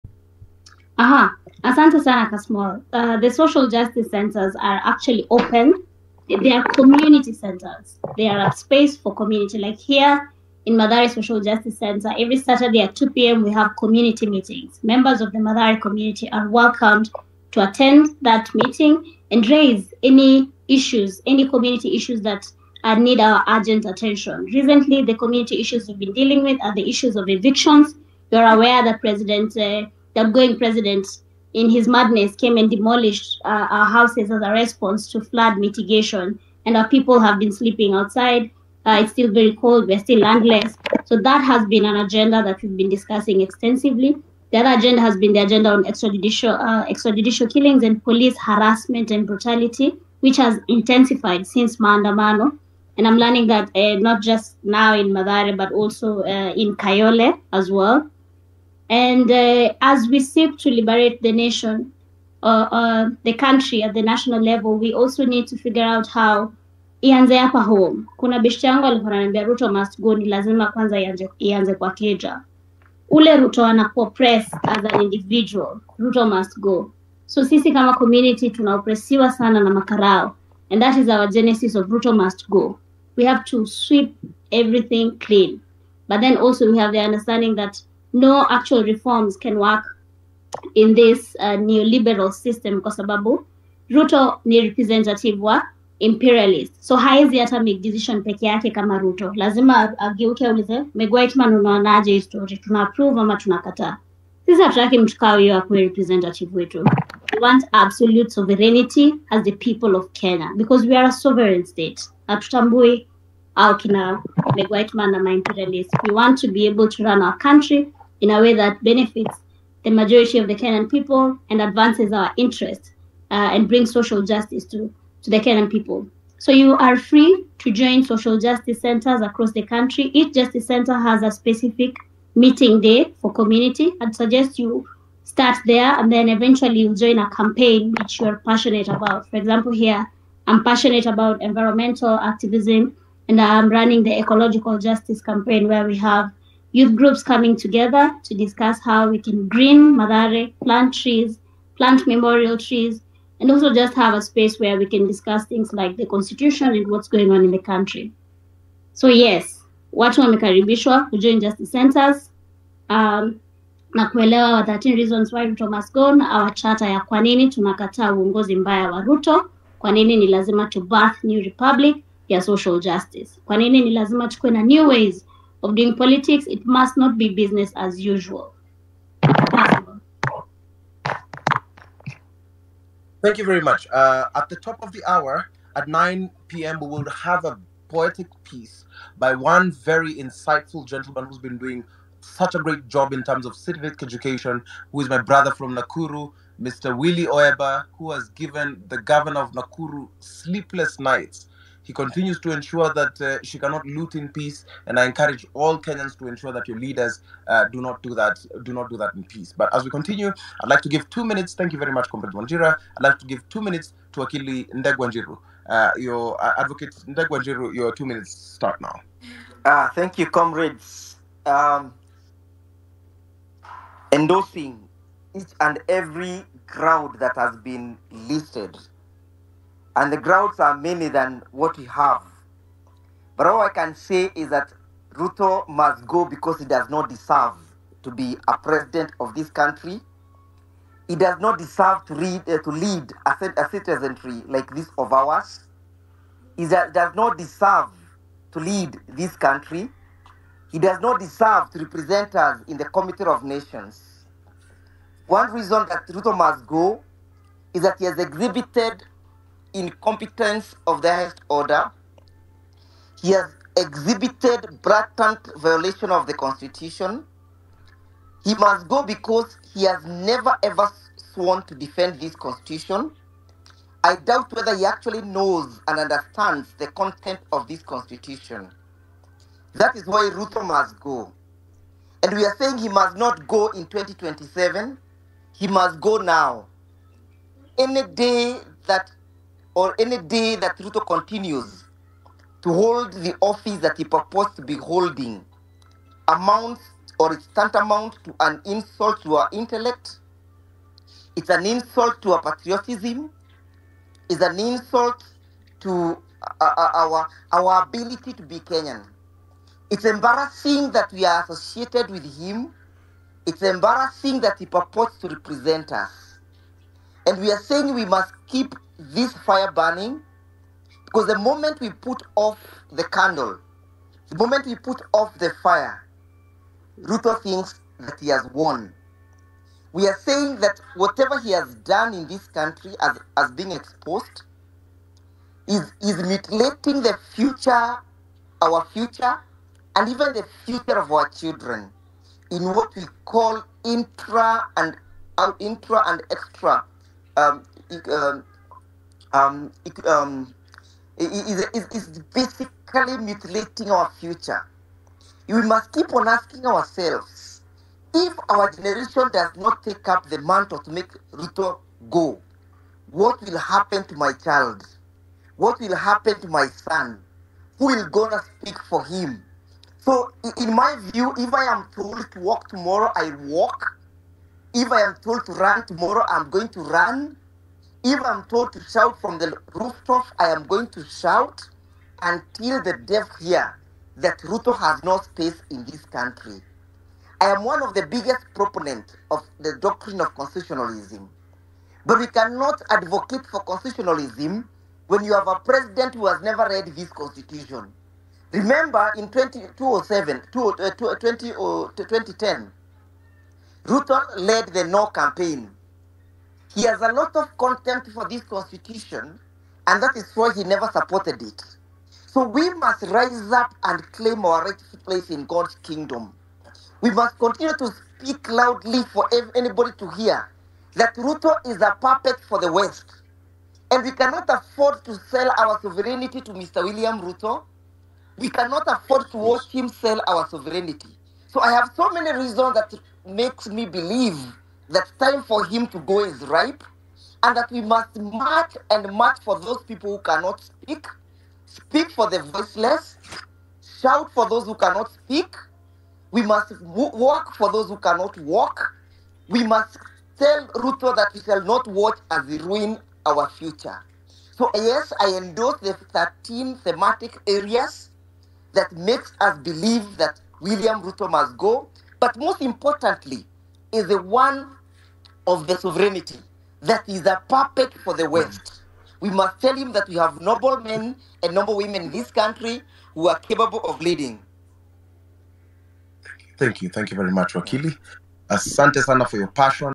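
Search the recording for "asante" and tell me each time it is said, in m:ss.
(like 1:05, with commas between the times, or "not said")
0:01, 7:58.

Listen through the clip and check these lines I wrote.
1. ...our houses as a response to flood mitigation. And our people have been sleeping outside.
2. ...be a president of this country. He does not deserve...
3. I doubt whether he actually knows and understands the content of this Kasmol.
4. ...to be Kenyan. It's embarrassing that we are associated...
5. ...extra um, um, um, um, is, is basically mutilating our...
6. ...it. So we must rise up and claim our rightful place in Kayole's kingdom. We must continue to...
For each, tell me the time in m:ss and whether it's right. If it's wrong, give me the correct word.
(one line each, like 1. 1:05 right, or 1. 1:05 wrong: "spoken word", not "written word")
1. 0:33 right
2. 3:58 right
3. 4:34 wrong: "Constitution", not "Kasmol"
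4. 5:08 right
5. 5:46 right
6. 6:51 wrong: "God", not "Kayole".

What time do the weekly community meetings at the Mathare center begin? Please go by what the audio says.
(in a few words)
2 p.m.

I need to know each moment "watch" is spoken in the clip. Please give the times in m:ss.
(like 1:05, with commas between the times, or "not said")
7:09, 7:31.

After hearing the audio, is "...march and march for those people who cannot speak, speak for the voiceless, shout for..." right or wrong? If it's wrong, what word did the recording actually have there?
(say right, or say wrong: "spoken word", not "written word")
right.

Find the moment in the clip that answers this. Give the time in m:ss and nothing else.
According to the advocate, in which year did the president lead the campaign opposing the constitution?
6:40.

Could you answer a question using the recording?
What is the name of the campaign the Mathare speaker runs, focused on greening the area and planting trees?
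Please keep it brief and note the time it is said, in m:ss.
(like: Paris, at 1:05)
ecological justice campaign, at 2:24.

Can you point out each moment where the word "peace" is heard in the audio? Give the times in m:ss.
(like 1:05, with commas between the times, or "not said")
3:24, 3:29.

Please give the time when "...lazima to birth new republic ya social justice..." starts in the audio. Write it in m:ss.
2:50.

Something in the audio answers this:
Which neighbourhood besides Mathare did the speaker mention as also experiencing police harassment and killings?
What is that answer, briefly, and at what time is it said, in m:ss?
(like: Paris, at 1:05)
Kayole, at 0:56.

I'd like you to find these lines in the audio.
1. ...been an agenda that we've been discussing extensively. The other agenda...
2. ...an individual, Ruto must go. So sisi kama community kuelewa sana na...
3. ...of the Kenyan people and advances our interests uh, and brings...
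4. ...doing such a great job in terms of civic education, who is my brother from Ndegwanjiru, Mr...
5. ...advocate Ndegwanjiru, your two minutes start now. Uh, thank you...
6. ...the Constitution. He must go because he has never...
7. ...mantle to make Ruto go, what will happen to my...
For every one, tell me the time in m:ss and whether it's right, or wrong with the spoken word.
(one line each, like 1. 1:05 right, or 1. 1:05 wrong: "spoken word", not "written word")
1. 0:41 right
2. 1:14 wrong: "tunaopresiwa", not "kuelewa"
3. 2:00 right
4. 3:11 wrong: "Nakuru", not "Ndegwanjiru"
5. 3:36 right
6. 4:26 right
7. 6:00 right.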